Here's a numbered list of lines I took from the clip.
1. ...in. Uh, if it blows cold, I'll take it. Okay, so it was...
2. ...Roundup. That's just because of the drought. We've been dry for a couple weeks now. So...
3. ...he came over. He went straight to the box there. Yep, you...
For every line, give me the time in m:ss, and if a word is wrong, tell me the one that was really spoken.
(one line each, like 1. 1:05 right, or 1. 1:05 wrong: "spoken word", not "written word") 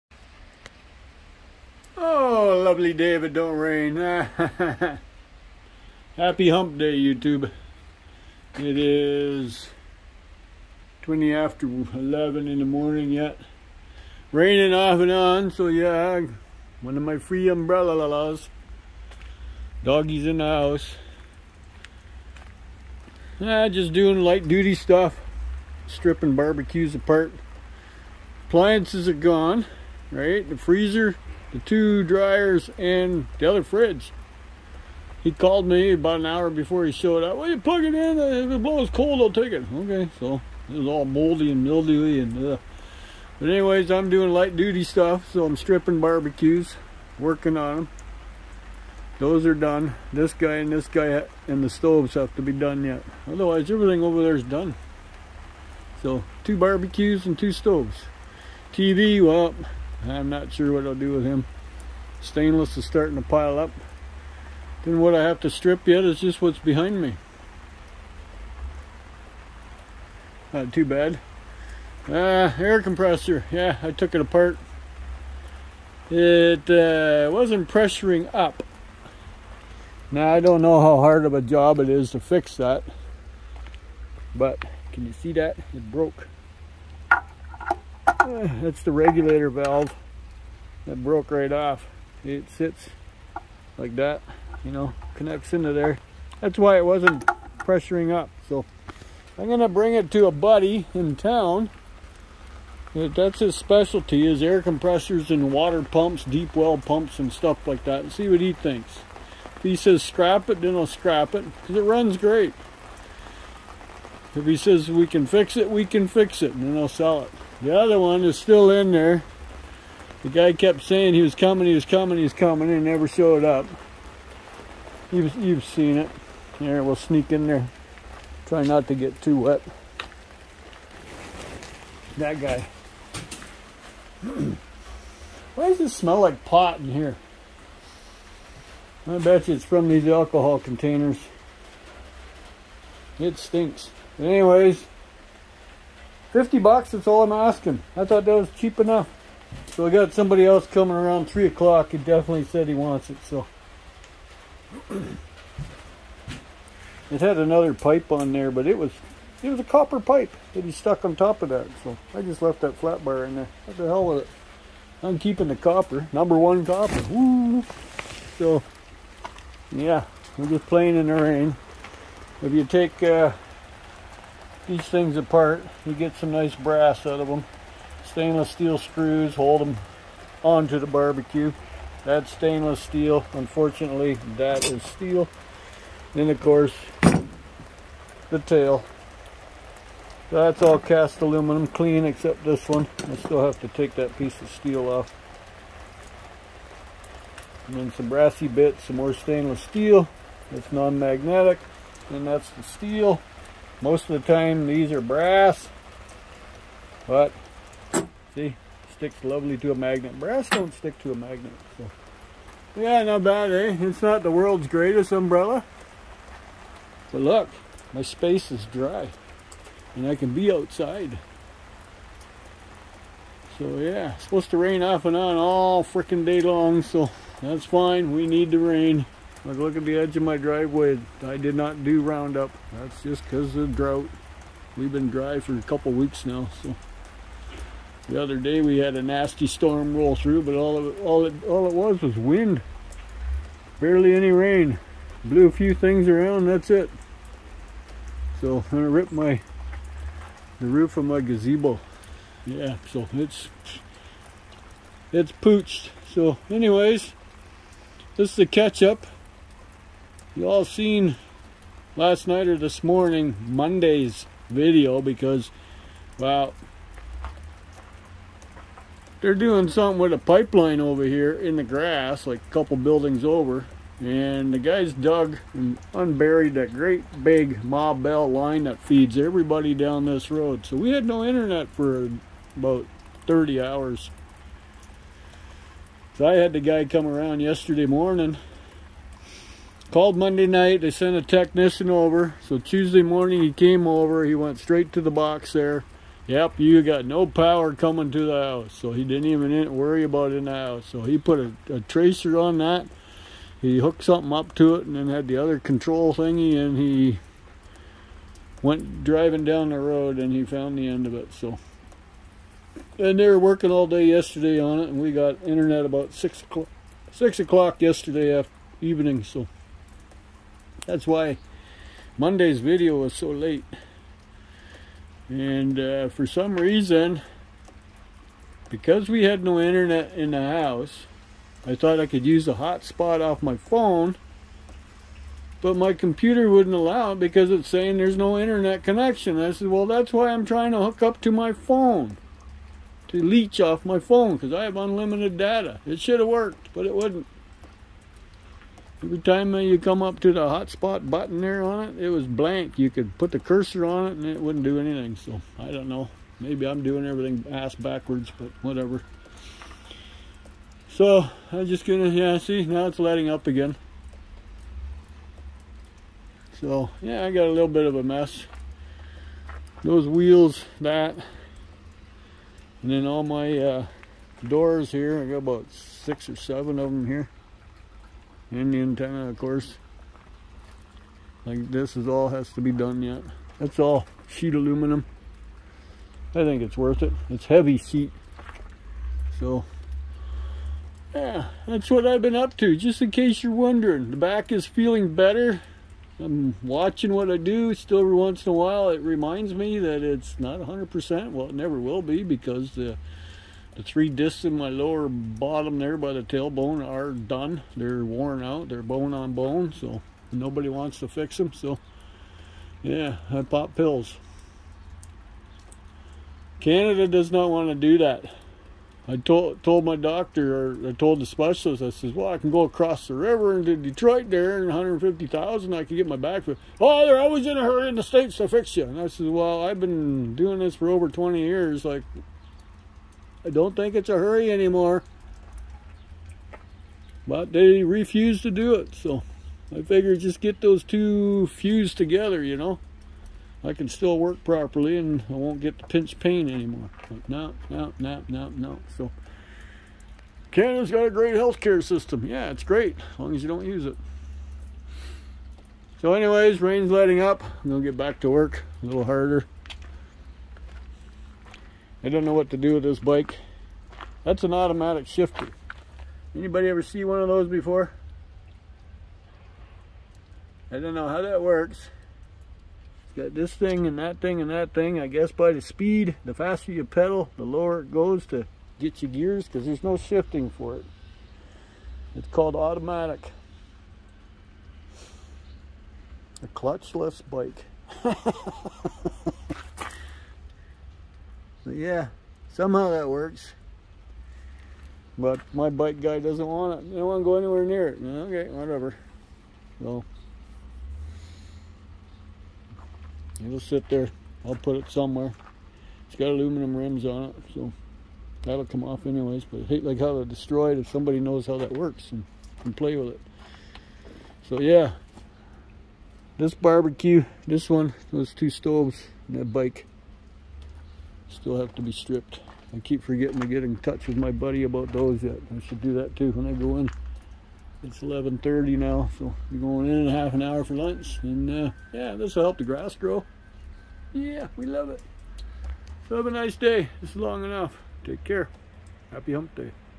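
1. 0:37 right
2. 3:52 right
3. 4:53 right.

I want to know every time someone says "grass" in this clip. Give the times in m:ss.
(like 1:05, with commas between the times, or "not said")
4:31, 8:52.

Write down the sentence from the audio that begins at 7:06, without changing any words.
Oh, they're always in a hurry in the States to fix you.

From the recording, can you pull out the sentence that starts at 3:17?
And then some brassy bits, some more stainless steel.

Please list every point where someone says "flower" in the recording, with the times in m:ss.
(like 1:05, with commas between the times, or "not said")
not said.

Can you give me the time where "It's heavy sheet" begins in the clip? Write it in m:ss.
6:27.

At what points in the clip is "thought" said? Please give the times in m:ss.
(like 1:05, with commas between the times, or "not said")
2:28, 5:31.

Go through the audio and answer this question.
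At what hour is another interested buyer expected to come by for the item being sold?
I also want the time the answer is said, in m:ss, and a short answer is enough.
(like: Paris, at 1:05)
3 o'clock, at 2:31.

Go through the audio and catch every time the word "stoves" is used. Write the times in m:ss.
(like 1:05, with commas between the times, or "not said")
0:51, 0:57, 8:38.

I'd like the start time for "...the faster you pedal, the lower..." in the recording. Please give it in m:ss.
7:56.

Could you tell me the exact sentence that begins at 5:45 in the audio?
It should have worked, but it wouldn't.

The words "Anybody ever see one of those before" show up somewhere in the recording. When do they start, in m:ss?
7:46.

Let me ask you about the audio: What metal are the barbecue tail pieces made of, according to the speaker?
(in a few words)
Cast aluminum.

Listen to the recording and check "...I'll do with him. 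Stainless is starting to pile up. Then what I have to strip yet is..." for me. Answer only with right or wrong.
right.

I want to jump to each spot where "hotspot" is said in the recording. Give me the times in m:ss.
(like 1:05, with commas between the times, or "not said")
5:32, 5:50.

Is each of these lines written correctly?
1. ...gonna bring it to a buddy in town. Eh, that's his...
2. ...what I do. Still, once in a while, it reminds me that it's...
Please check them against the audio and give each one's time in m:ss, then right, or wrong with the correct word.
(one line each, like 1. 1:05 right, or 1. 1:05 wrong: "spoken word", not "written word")
1. 1:39 right
2. 6:37 right.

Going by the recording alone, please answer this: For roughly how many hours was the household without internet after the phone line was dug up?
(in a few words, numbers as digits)
30 hours.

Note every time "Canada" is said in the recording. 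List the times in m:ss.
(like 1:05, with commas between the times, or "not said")
6:56, 7:30.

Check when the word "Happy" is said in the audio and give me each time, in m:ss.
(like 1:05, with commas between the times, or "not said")
0:06, 8:59.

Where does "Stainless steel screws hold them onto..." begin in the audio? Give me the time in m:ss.
2:58.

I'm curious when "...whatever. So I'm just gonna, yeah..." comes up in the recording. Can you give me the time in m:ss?
5:58.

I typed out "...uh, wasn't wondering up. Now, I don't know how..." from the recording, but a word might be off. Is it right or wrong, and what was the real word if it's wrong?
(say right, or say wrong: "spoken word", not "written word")
wrong: "pressuring", not "wondering".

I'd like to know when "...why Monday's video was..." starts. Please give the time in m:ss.
5:21.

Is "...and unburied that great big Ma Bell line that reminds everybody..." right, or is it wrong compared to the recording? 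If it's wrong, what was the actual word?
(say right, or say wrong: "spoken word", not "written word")
wrong: "feeds", not "reminds".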